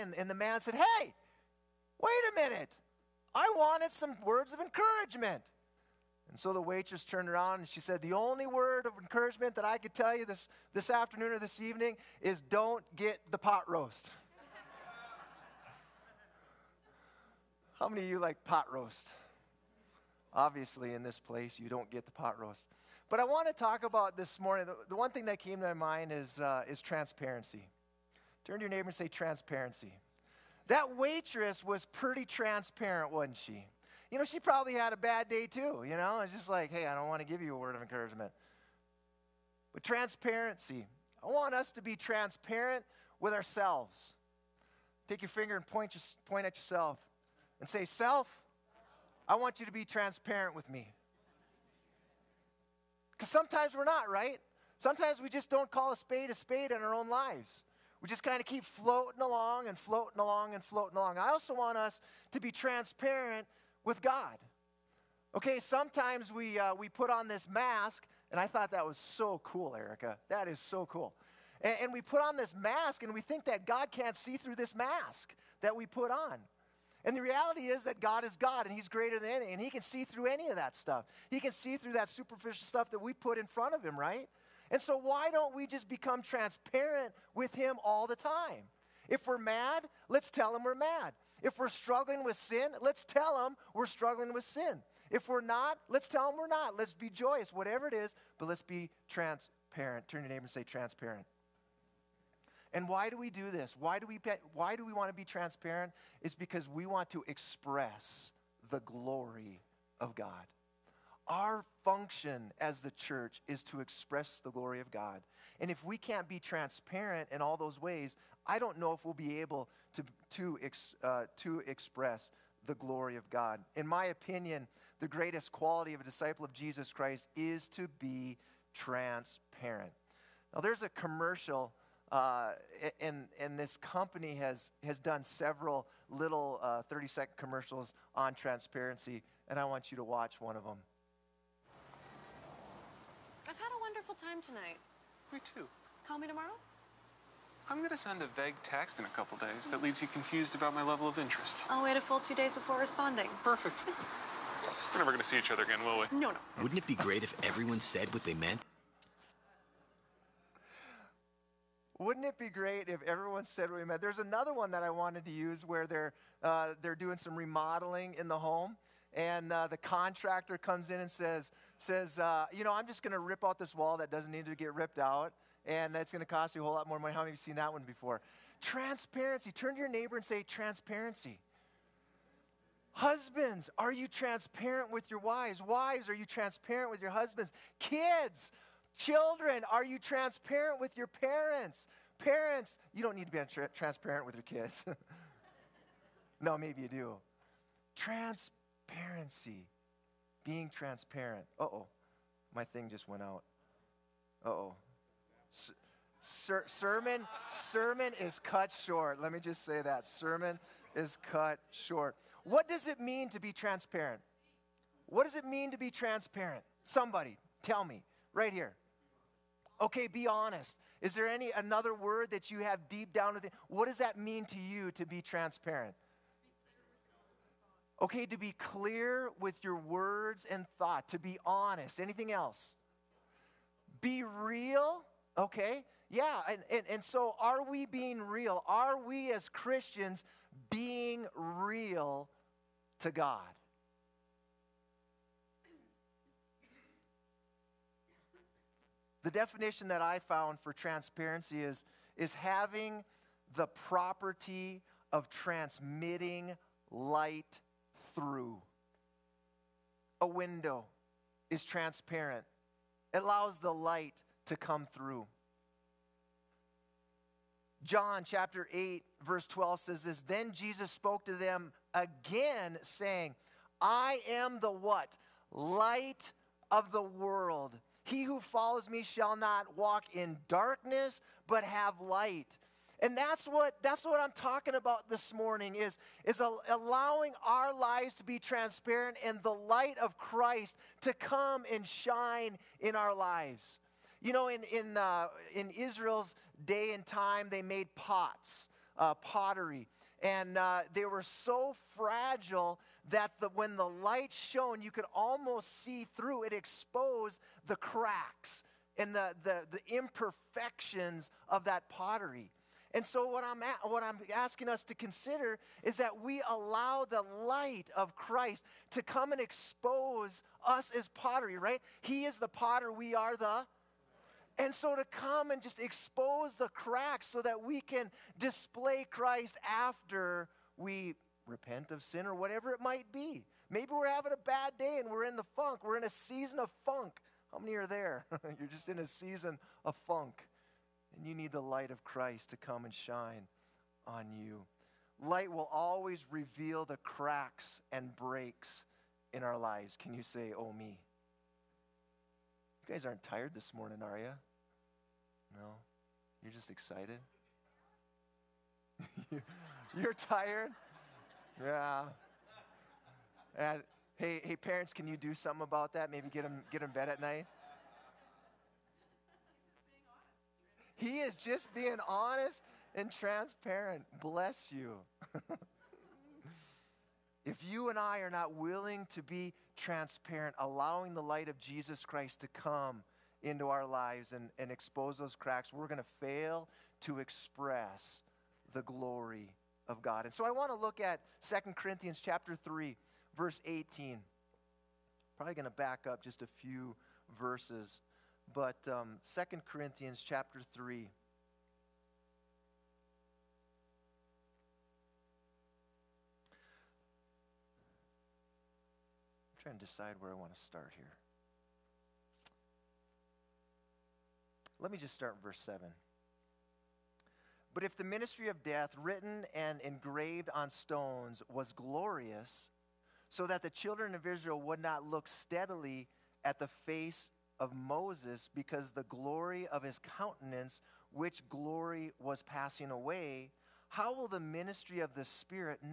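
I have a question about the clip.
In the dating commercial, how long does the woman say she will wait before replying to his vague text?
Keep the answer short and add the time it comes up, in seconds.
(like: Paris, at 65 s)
two days, at 151 s.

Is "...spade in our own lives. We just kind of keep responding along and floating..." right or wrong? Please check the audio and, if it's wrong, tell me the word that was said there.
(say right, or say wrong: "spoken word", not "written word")
wrong: "floating", not "responding".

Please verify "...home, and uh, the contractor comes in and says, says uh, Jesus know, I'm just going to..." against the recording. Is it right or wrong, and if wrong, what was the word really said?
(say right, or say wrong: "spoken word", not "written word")
wrong: "You", not "Jesus".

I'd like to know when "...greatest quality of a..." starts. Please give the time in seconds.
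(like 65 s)
125 s.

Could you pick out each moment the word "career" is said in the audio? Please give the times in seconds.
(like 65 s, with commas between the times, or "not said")
not said.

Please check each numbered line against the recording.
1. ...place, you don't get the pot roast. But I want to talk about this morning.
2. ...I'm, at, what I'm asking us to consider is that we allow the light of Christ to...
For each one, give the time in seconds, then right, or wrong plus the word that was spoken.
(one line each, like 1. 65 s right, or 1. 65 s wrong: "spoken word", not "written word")
1. 21 s right
2. 313 s right.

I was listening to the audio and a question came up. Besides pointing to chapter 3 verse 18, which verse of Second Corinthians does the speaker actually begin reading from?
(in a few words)
verse 7.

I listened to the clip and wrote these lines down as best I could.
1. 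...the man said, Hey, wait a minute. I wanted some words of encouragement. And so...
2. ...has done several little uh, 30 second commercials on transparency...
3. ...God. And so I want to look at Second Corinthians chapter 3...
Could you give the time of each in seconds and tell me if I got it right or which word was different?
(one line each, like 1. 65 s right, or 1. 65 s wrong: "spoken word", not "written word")
1. 0 s right
2. 134 s right
3. 390 s right.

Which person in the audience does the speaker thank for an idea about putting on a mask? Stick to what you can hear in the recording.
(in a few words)
Erica.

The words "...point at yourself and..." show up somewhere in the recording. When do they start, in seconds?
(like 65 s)
46 s.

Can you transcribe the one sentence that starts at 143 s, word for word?
I've had a wonderful time tonight.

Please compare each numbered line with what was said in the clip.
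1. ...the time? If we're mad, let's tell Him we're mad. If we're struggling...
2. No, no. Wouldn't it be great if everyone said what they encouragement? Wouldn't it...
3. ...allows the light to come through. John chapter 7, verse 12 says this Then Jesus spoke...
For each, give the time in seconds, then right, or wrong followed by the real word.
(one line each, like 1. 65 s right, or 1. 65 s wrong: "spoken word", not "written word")
1. 88 s right
2. 156 s wrong: "meant", not "encouragement"
3. 263 s wrong: "8", not "7".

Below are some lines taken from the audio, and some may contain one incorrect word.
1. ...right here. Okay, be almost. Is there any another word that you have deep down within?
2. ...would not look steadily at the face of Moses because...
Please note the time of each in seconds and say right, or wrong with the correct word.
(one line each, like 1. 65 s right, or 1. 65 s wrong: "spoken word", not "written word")
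1. 218 s wrong: "honest", not "almost"
2. 424 s right.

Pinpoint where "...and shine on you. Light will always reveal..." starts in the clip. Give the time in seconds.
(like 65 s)
342 s.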